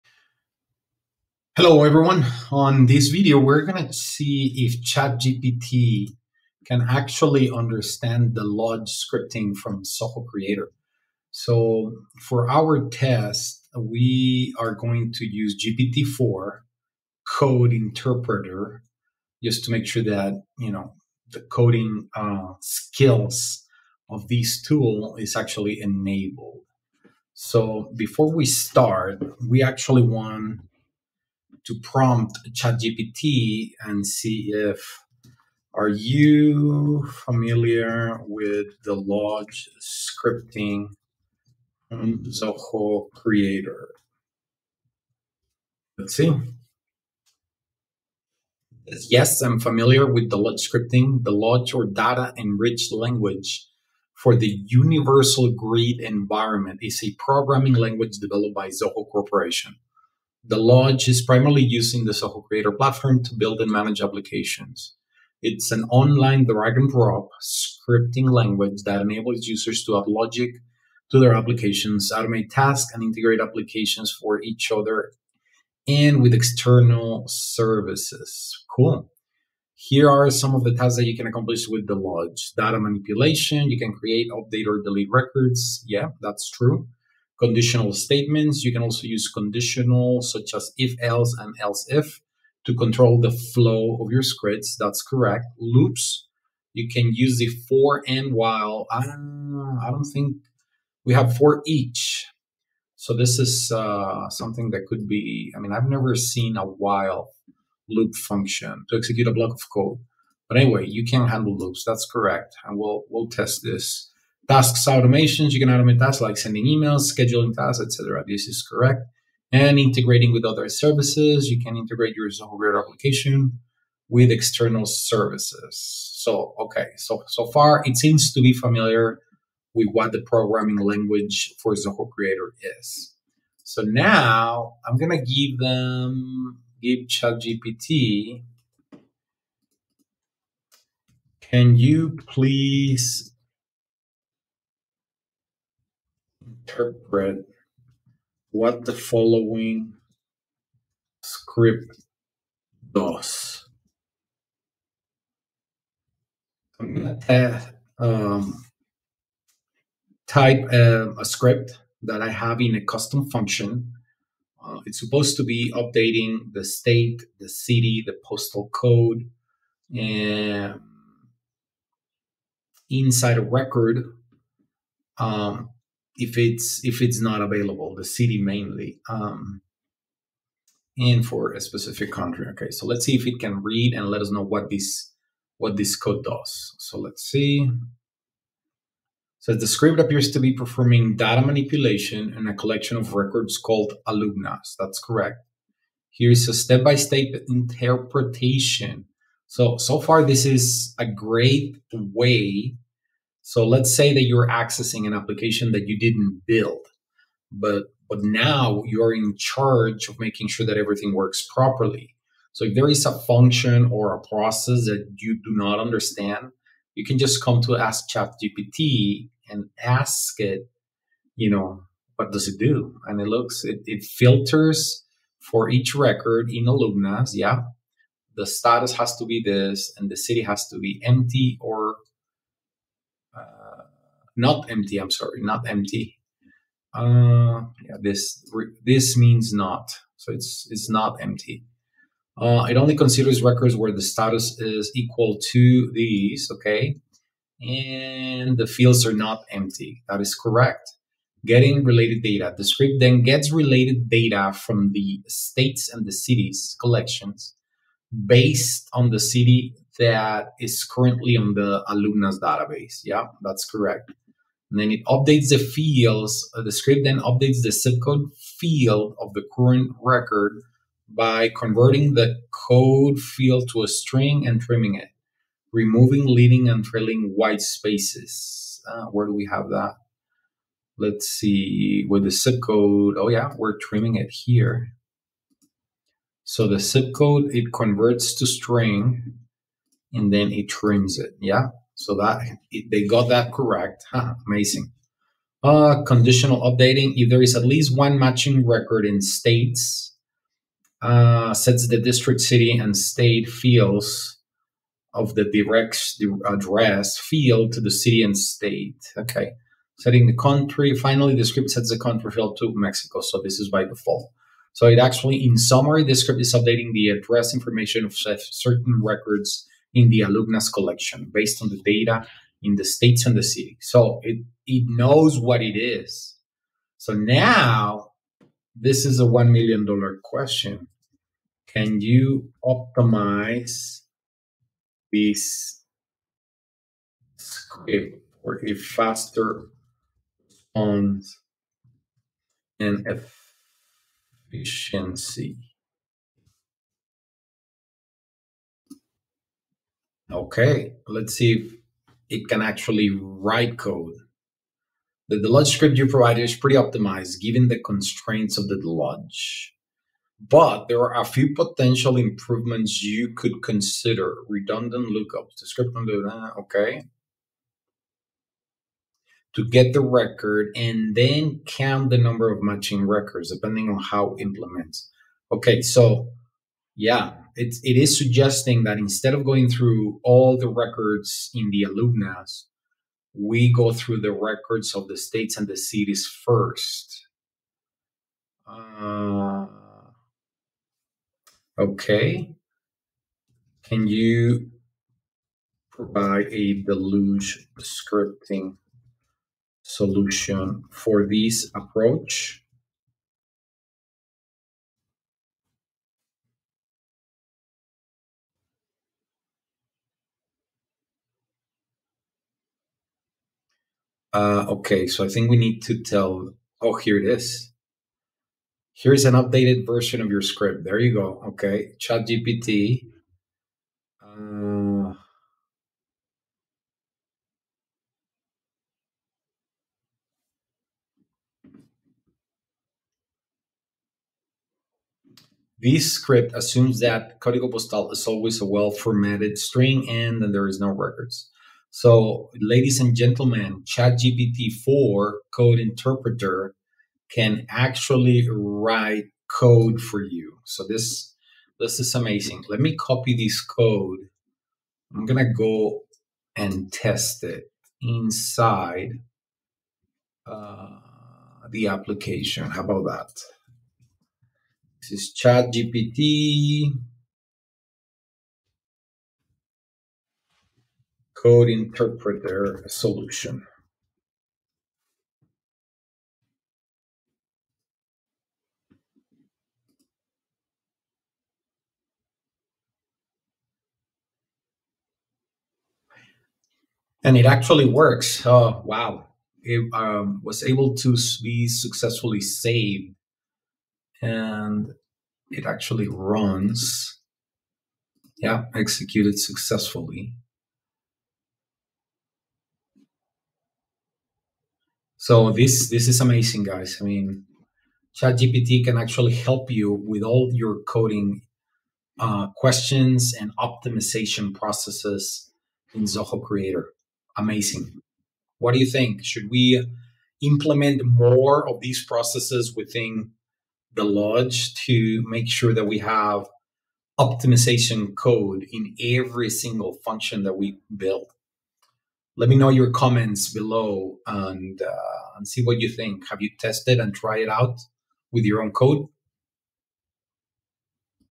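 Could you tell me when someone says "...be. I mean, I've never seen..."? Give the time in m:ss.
1:45.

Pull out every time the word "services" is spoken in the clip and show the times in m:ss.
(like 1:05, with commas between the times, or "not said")
1:17, 2:00, 2:04.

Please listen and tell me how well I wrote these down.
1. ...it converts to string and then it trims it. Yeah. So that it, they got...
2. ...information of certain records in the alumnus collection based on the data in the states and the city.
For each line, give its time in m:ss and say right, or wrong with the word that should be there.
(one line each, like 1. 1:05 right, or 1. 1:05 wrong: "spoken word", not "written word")
1. 4:47 right
2. 5:17 right.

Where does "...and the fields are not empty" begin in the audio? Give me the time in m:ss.
4:07.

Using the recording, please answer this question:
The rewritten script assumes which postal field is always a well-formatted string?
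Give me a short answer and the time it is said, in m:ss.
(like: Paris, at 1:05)
Código Postal, at 7:17.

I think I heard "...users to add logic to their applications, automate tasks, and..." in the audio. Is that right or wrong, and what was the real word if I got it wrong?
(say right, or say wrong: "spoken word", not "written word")
right.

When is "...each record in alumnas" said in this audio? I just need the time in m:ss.
3:45.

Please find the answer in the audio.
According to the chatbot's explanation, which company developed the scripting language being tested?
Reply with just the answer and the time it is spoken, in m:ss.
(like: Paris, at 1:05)
Zoho Corporation, at 0:58.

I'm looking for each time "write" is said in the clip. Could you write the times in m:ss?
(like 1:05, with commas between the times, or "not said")
5:53, 7:28.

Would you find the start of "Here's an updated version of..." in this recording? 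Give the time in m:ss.
6:58.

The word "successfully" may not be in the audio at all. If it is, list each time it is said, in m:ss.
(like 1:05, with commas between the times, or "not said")
8:11, 8:19.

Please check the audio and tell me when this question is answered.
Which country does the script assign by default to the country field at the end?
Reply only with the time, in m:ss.
5:12.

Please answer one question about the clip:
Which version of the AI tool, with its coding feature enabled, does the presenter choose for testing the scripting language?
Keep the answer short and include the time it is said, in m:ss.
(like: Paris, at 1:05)
GPT-4 code interpreter, at 0:15.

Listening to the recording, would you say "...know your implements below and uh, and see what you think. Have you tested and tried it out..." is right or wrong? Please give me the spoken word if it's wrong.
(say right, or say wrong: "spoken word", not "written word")
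wrong: "comments", not "implements".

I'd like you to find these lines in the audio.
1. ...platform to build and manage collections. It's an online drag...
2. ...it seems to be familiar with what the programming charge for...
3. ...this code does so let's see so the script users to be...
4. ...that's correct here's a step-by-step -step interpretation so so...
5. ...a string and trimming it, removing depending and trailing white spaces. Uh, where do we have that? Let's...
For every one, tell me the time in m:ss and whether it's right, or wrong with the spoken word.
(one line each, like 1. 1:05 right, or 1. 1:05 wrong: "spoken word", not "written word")
1. 1:02 wrong: "applications", not "collections"
2. 2:07 wrong: "language", not "charge"
3. 3:05 wrong: "appears", not "users"
4. 3:14 right
5. 4:33 wrong: "leading", not "depending".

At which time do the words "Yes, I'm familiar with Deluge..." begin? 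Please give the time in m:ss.
0:49.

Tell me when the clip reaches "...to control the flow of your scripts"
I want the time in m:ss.
1:32.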